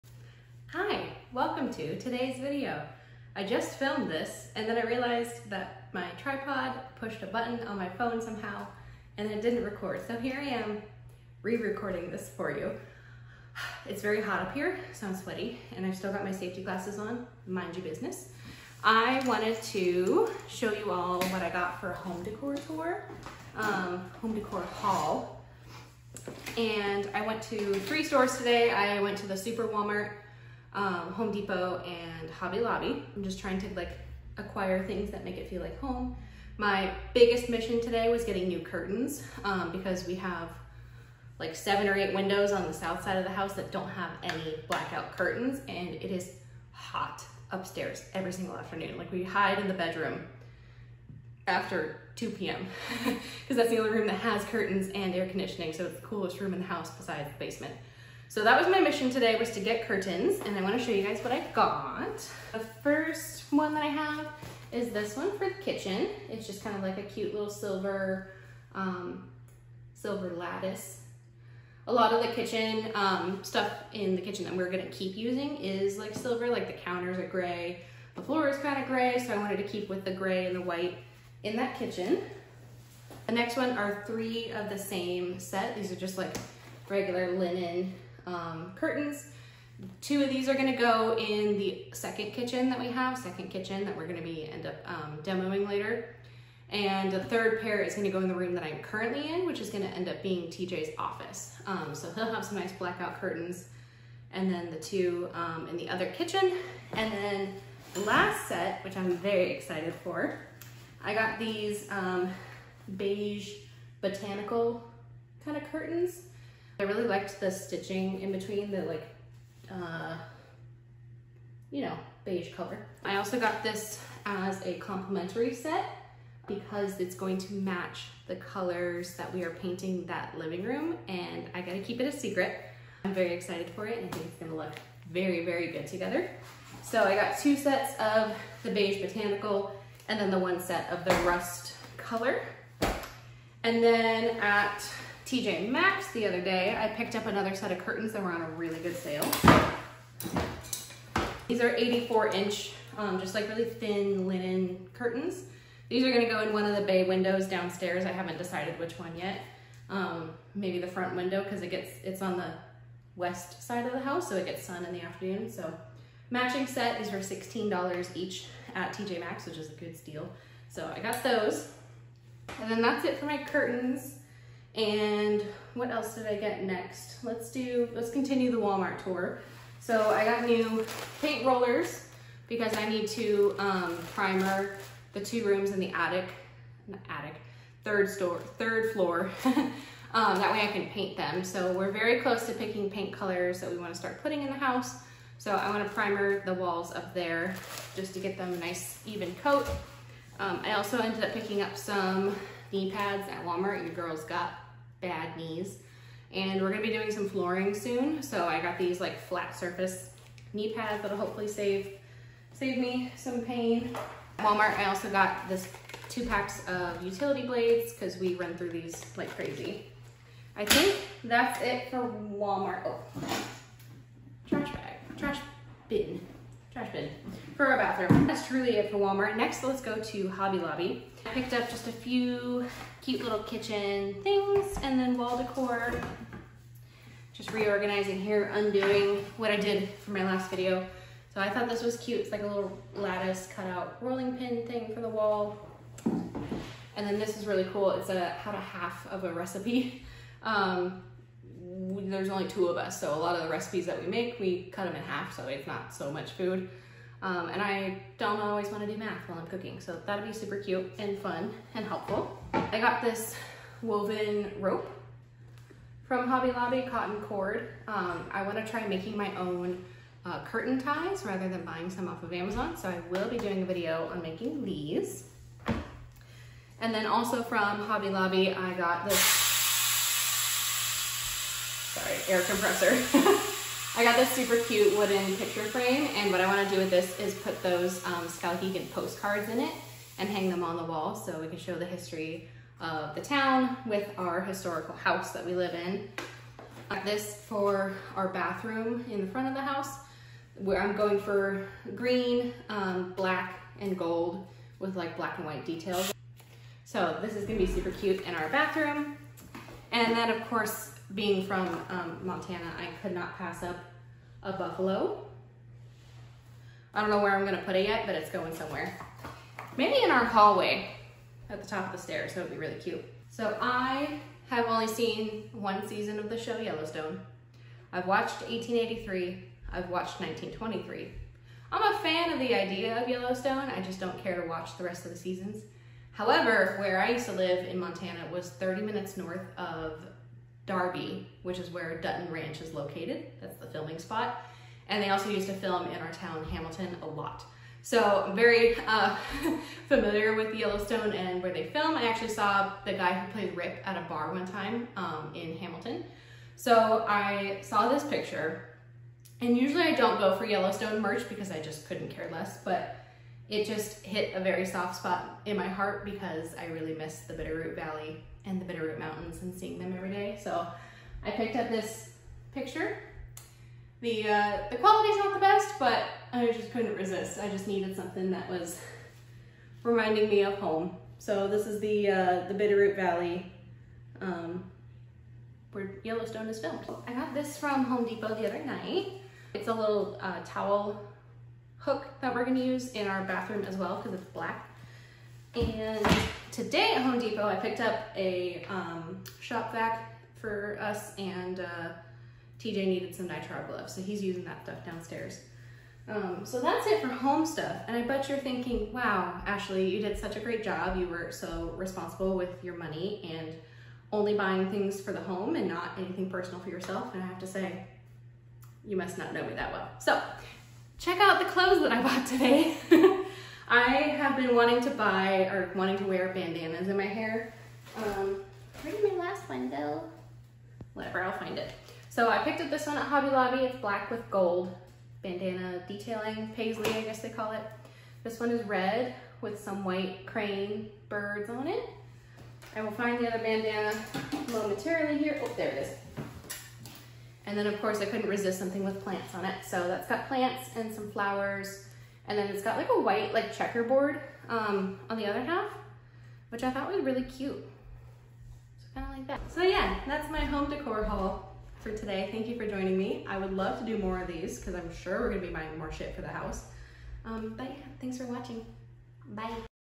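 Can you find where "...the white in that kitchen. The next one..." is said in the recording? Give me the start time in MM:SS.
01:20.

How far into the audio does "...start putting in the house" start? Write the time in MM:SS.
03:13.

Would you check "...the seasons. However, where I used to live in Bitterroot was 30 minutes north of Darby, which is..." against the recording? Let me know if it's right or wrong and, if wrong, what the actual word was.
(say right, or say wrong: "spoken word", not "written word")
wrong: "Montana", not "Bitterroot".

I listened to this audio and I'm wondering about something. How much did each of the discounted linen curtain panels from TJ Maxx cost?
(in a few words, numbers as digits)
$16.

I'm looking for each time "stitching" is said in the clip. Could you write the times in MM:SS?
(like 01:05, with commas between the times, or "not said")
01:57.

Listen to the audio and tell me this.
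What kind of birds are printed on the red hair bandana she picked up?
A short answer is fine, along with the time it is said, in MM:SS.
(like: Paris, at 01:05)
crane birds, at 07:20.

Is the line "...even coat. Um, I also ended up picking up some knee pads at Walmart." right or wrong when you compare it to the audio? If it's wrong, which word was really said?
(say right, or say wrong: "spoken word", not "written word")
right.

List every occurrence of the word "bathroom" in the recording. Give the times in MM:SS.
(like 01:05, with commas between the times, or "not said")
03:47, 04:58, 05:08, 06:33.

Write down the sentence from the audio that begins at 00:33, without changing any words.
I'm just trying to like acquire things that make it feel like home.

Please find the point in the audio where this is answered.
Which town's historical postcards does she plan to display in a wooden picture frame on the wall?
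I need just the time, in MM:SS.
04:48.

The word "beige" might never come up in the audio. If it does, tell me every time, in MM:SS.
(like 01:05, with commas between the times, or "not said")
01:52, 02:02, 02:18.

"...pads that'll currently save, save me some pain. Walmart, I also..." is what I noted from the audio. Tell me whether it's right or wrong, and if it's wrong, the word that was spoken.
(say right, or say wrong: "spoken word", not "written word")
wrong: "hopefully", not "currently".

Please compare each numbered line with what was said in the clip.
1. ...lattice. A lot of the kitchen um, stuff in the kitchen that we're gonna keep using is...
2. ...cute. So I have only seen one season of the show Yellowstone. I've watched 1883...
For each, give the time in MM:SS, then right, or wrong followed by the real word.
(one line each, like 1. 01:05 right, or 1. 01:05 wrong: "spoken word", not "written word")
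1. 01:10 right
2. 05:22 right.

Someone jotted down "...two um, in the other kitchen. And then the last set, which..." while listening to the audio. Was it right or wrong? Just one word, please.
right.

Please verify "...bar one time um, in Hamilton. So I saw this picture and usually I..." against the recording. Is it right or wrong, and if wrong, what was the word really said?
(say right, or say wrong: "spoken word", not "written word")
right.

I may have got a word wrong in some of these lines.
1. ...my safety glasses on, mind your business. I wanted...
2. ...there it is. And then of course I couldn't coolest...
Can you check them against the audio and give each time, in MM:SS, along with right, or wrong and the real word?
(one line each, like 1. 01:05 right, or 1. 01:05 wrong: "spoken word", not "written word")
1. 00:16 right
2. 07:25 wrong: "resist", not "coolest".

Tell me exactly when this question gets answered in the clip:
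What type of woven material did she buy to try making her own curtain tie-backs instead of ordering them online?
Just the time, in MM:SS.
04:26.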